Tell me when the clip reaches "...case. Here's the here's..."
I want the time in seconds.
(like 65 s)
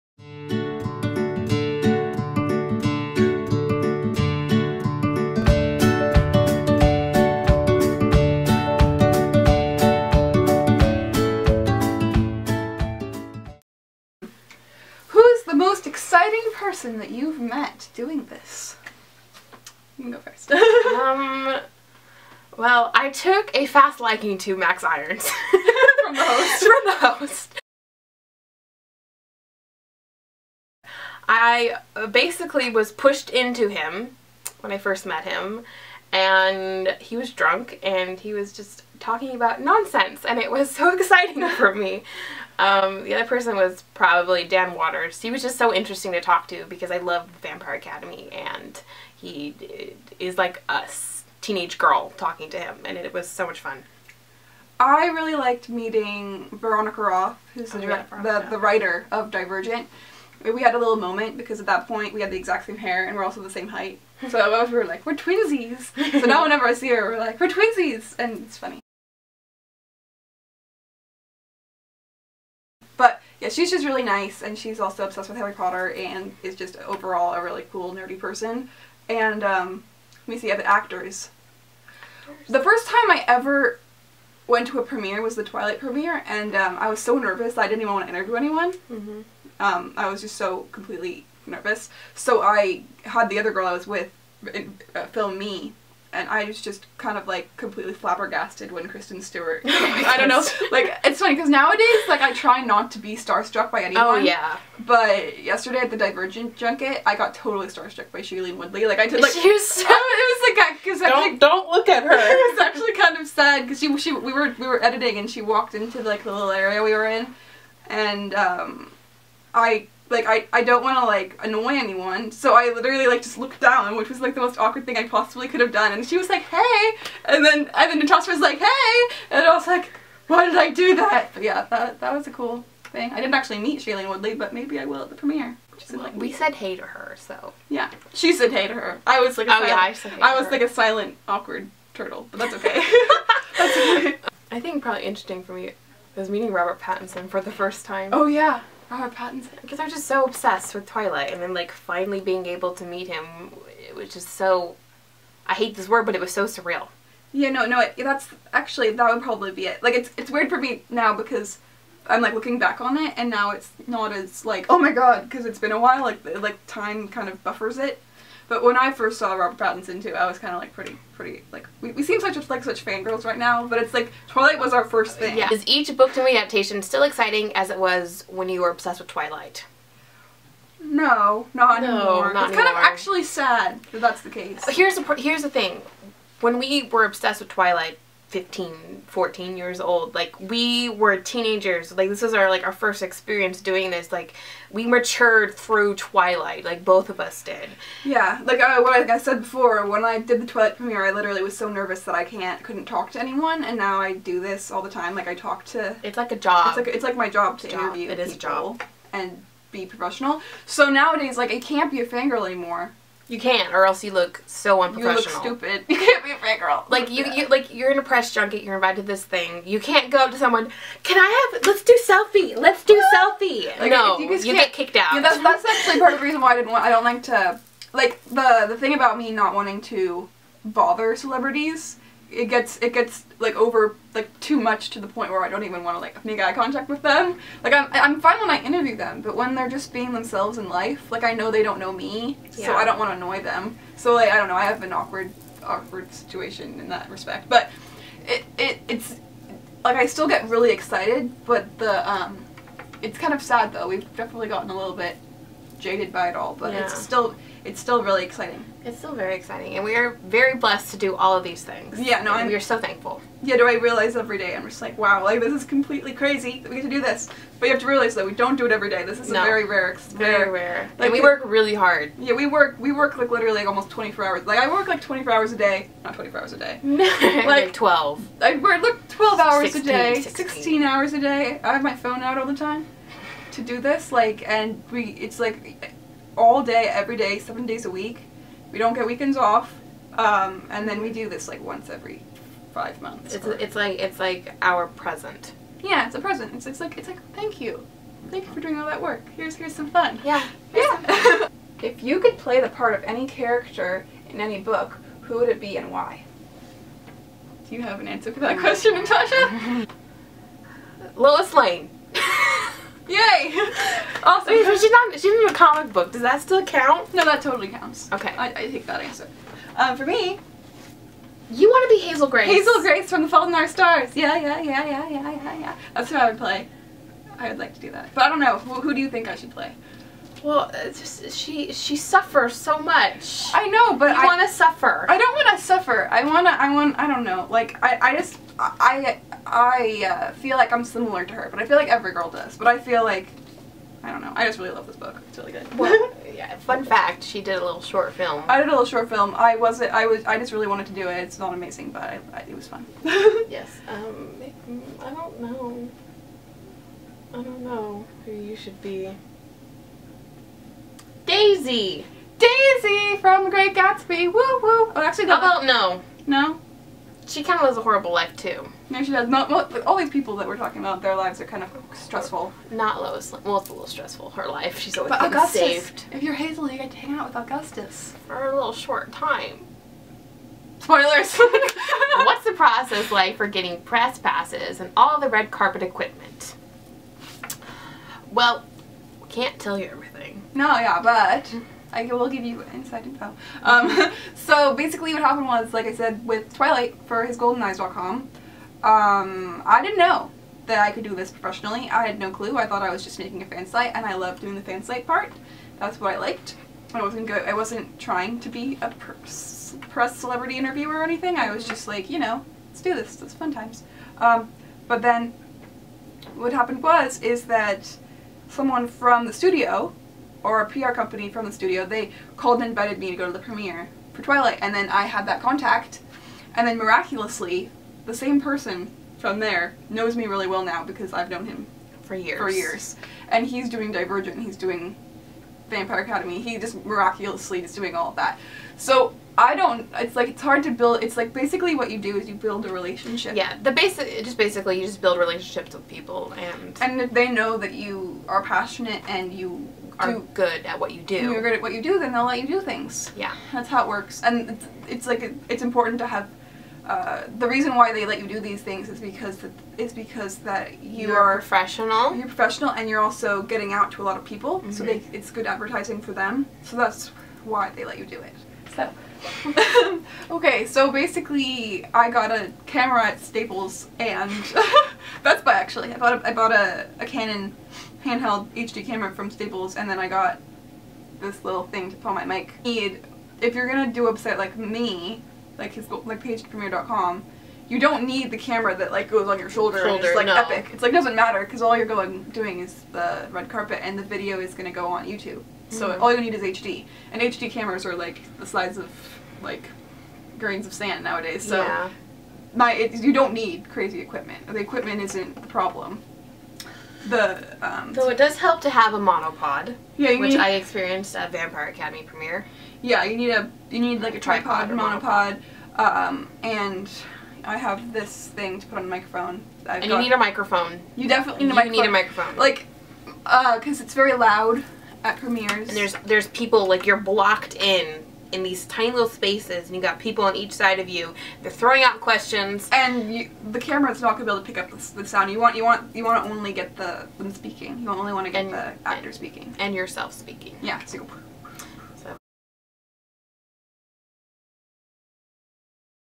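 184 s.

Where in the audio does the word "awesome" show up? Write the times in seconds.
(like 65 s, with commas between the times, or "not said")
314 s.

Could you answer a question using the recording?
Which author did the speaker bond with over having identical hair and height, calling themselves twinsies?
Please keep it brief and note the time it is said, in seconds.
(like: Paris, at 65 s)
Veronica Roth, at 56 s.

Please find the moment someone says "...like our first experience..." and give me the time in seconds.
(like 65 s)
192 s.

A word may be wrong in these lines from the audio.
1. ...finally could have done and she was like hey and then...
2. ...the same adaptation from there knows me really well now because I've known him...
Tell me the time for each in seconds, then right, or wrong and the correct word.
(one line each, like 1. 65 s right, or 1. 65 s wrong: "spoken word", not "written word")
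1. 125 s wrong: "possibly", not "finally"
2. 428 s wrong: "person", not "adaptation".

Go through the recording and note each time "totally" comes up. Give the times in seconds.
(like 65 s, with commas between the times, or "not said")
107 s, 317 s.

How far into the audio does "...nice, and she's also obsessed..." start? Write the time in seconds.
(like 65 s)
74 s.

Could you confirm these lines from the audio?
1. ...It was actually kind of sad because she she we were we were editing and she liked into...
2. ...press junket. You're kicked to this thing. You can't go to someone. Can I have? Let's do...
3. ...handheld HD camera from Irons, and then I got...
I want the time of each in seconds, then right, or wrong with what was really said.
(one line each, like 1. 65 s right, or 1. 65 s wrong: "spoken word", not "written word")
1. 112 s wrong: "walked", not "liked"
2. 218 s wrong: "invited", not "kicked"
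3. 478 s wrong: "Staples", not "Irons".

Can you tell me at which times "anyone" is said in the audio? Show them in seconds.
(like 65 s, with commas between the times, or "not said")
88 s, 103 s, 121 s, 203 s.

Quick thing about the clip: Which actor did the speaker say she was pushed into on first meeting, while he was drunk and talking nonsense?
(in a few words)
Max Irons.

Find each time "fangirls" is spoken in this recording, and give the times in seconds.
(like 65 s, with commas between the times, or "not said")
172 s, 212 s.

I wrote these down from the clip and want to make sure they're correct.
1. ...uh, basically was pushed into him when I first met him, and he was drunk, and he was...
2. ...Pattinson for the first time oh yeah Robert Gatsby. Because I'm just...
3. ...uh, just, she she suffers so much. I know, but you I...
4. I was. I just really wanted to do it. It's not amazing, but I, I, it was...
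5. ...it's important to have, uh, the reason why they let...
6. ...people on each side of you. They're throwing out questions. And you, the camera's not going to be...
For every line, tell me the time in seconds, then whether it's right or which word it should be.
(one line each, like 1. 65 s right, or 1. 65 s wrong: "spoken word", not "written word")
1. 31 s right
2. 146 s wrong: "Pattinson", not "Gatsby"
3. 330 s right
4. 349 s right
5. 455 s right
6. 529 s right.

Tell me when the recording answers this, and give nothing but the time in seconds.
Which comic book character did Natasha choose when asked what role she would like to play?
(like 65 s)
311 s.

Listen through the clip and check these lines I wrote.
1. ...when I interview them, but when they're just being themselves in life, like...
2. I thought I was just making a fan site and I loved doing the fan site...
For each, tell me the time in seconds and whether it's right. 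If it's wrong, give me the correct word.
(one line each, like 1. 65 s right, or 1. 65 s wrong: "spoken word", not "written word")
1. 238 s right
2. 402 s right.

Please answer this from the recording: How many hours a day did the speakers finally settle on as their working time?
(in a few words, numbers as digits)
16.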